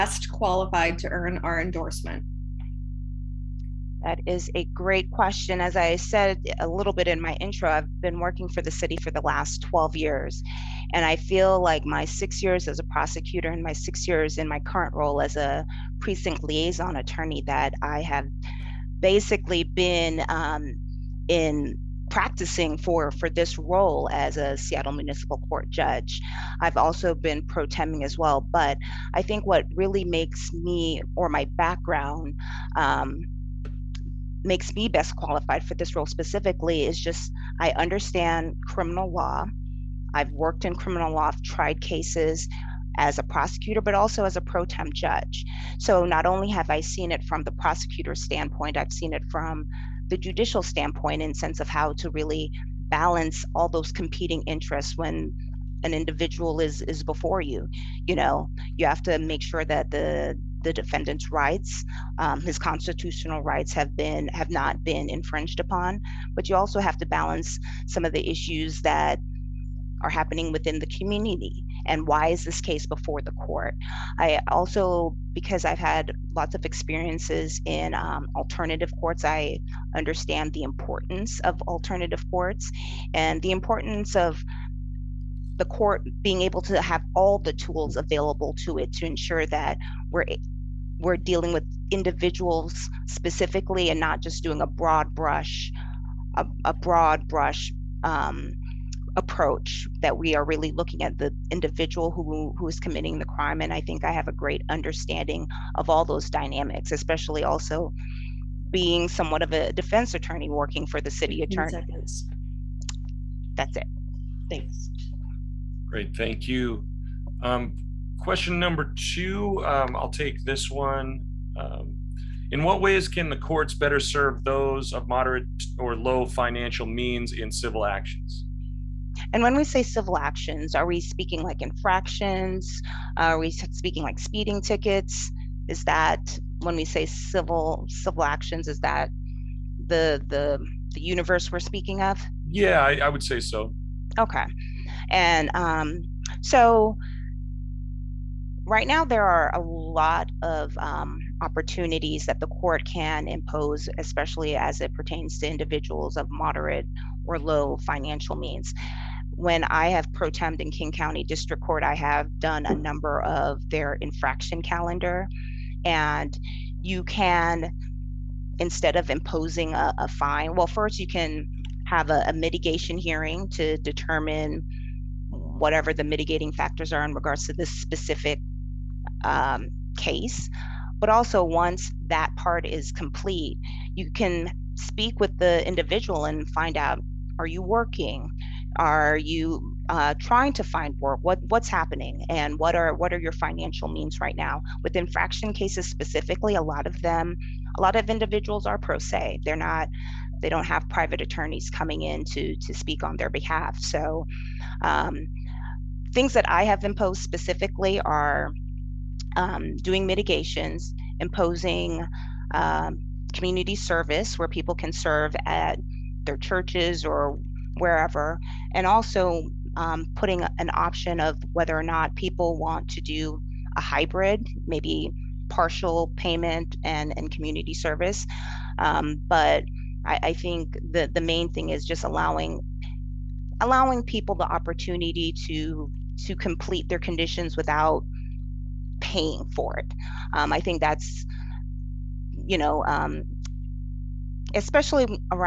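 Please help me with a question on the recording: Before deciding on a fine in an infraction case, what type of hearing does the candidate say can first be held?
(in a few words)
Mitigation hearing.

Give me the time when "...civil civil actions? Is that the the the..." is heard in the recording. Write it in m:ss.
2:17.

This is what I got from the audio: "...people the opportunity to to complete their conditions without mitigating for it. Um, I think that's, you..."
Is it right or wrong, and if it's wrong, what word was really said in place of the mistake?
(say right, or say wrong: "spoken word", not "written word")
wrong: "paying", not "mitigating".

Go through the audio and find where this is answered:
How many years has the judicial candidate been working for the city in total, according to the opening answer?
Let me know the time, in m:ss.
0:09.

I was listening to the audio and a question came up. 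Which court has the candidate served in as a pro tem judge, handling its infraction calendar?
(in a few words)
King County District Court.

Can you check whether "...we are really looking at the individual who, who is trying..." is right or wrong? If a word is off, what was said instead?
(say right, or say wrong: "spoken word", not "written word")
wrong: "committing", not "trying".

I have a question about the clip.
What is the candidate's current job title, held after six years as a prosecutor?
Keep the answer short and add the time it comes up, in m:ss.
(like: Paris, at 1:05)
Precinct liaison attorney, at 0:16.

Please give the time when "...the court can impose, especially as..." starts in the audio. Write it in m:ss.
2:32.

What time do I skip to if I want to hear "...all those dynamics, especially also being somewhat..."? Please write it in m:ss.
1:45.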